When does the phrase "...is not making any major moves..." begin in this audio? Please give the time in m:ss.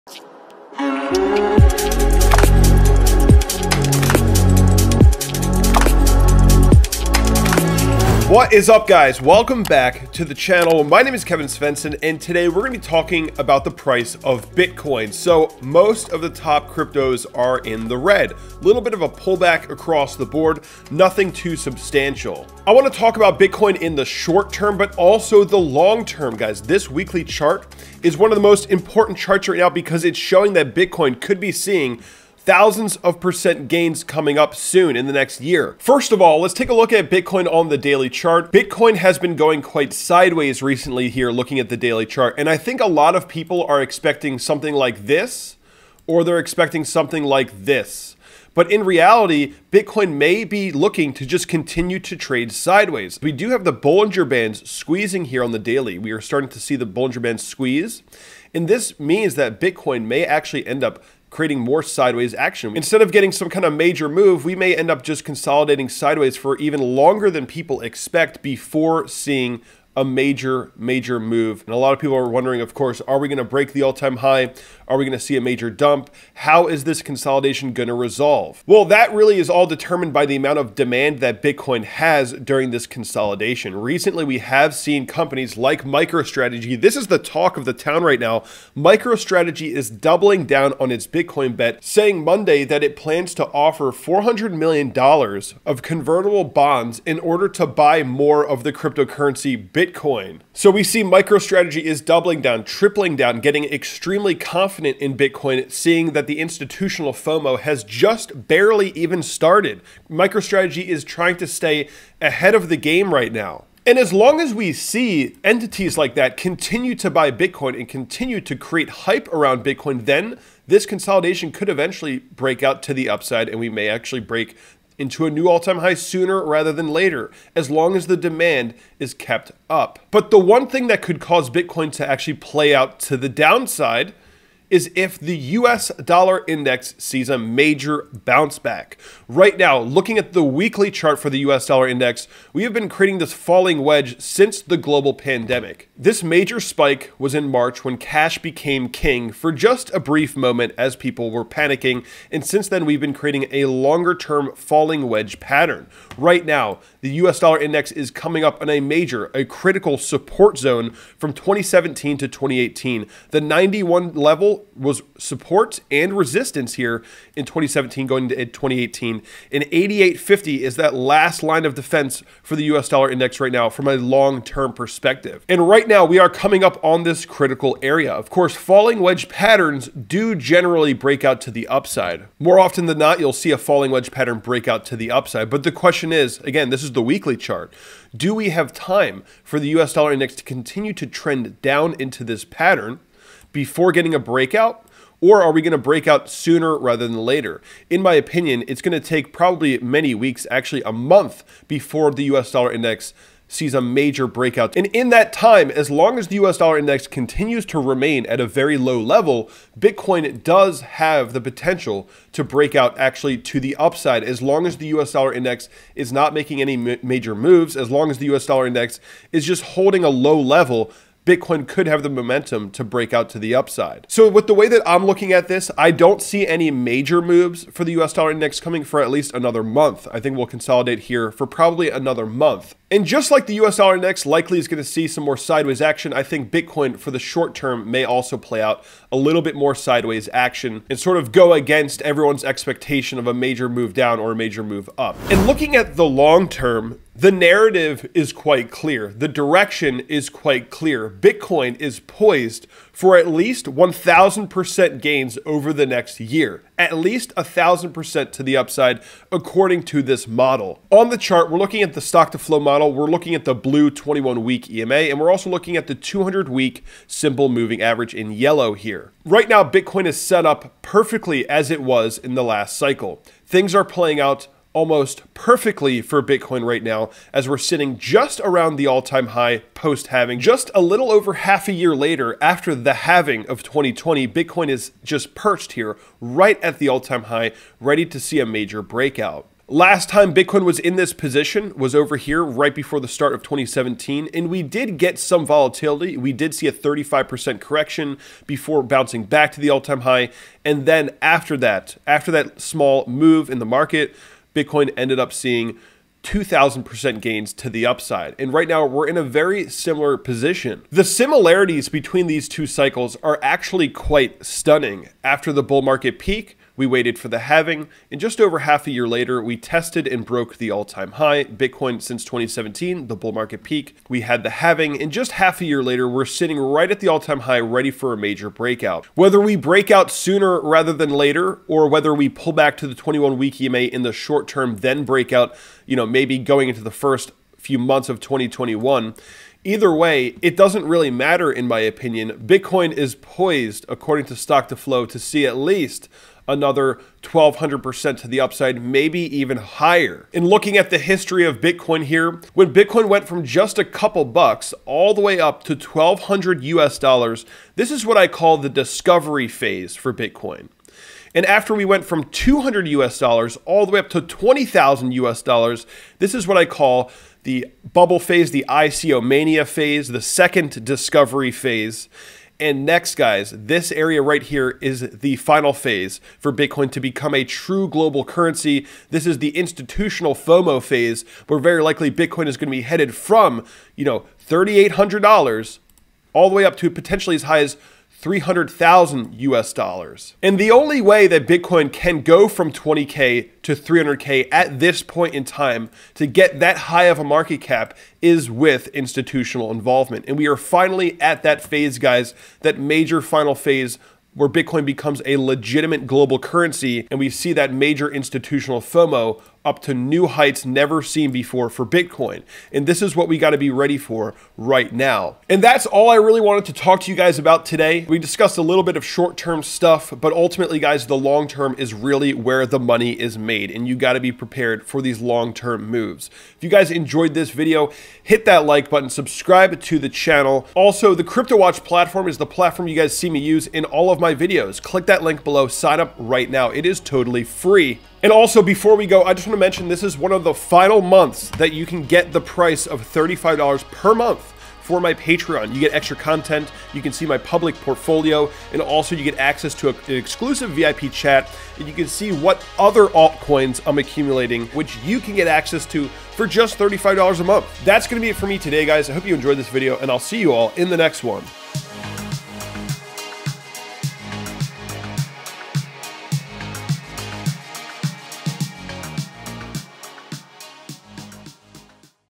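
3:35.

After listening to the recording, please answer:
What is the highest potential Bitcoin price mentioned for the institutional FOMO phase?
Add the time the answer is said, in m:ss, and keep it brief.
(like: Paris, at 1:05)
$300,000, at 6:28.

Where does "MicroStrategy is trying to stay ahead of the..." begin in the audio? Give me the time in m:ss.
1:50.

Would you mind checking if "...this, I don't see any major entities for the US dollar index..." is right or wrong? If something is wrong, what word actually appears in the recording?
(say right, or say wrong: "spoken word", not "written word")
wrong: "moves", not "entities".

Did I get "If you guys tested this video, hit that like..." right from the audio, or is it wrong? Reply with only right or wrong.
wrong.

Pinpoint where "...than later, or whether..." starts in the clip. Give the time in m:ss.
5:30.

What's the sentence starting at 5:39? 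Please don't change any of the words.
Either way, it doesn't really matter in my opinion.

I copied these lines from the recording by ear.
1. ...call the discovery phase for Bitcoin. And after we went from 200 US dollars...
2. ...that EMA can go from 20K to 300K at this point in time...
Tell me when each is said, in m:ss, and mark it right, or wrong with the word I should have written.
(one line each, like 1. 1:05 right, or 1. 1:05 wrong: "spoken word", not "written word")
1. 5:58 right
2. 6:31 wrong: "Bitcoin", not "EMA".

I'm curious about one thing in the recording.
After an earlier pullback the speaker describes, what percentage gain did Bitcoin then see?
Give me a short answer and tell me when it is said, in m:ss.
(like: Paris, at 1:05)
2000%, at 5:06.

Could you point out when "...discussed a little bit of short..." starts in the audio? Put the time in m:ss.
6:58.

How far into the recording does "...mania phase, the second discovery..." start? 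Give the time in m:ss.
6:09.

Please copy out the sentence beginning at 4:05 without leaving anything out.
And looking at the long term, the narrative is quite clear.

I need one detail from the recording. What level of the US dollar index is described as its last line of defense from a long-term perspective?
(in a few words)
88.50.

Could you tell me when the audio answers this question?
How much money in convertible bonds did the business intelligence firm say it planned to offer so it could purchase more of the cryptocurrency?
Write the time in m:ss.
1:33.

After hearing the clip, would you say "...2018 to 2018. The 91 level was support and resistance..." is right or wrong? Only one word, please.
wrong.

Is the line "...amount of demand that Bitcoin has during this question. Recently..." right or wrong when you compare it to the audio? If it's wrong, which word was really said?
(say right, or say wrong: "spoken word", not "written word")
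wrong: "consolidation", not "question".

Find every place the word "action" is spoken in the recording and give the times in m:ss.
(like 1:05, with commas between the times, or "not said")
1:02, 3:55, 4:00.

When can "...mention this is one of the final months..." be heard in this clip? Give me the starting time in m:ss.
7:19.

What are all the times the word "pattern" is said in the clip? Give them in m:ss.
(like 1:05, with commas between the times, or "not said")
2:35, 2:59, 3:04, 3:12.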